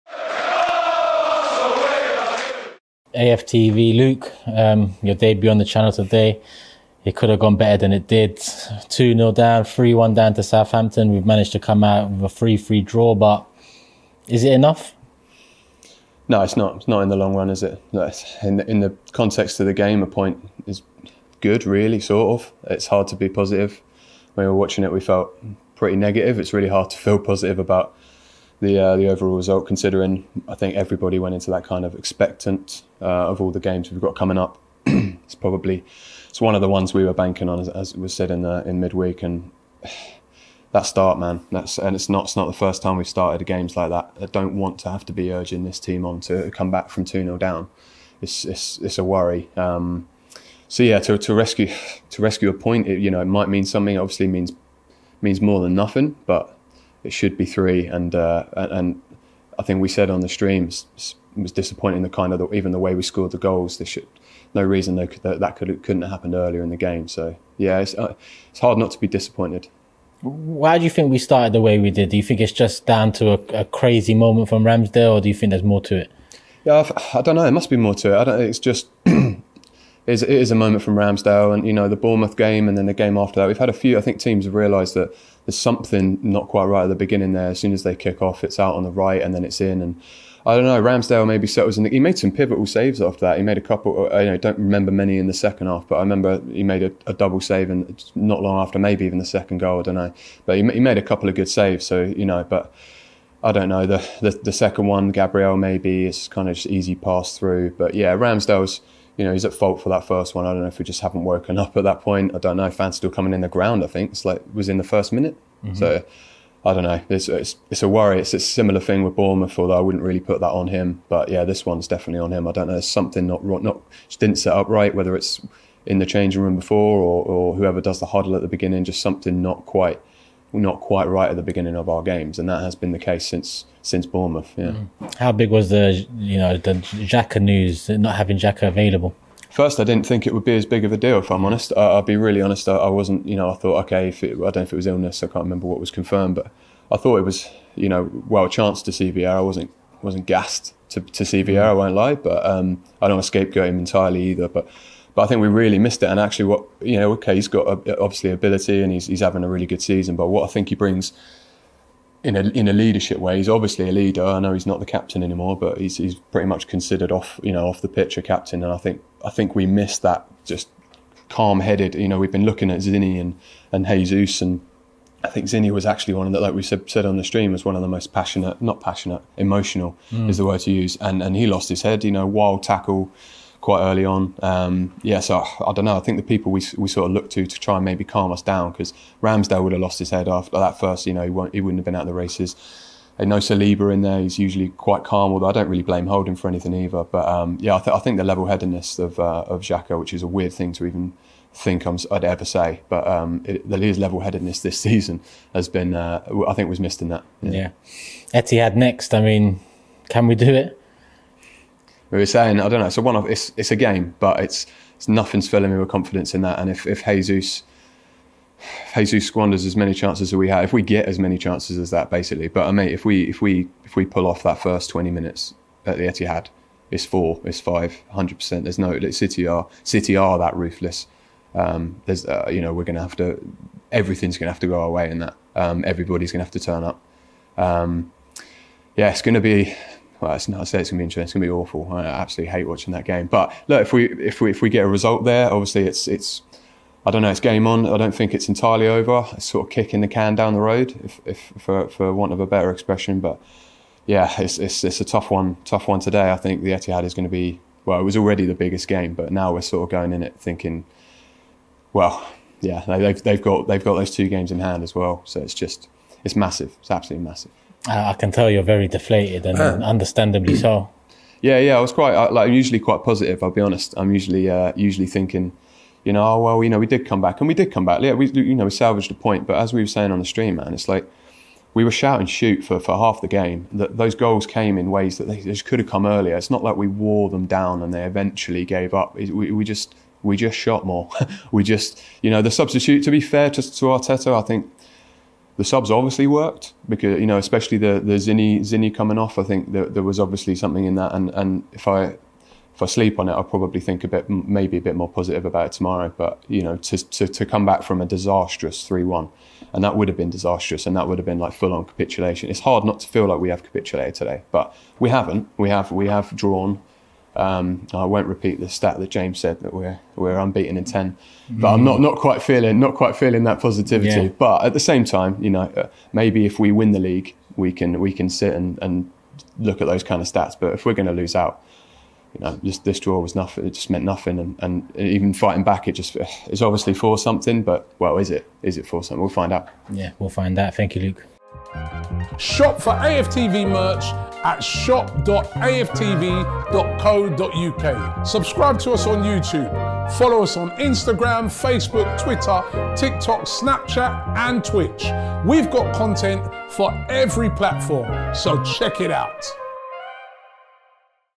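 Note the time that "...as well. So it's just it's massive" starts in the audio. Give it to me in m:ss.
4:24.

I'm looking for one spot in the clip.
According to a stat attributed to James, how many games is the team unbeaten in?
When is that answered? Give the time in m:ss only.
5:20.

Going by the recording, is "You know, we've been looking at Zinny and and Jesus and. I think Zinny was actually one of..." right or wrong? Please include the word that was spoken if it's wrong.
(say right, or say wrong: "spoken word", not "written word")
right.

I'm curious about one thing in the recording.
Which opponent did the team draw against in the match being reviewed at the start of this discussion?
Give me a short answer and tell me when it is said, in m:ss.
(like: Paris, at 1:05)
Southampton, at 0:10.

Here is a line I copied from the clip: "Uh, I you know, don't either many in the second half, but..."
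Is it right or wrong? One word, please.
wrong.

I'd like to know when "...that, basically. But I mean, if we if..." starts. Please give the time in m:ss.
3:41.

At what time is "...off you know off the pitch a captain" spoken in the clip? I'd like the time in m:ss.
2:47.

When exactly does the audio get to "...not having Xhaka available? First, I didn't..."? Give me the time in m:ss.
2:17.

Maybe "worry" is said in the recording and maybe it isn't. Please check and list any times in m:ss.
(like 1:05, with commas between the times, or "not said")
0:49, 1:57.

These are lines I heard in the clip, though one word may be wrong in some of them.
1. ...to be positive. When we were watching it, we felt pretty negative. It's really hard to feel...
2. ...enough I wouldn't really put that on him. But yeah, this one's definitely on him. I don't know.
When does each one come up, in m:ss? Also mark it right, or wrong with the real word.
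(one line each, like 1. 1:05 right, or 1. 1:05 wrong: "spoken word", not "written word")
1. 0:23 right
2. 1:59 wrong: "although", not "enough".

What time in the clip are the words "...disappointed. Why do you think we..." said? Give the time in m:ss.
1:09.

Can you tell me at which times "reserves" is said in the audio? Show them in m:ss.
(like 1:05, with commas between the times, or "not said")
not said.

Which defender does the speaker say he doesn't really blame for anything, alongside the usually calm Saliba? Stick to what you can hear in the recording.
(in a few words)
Holding.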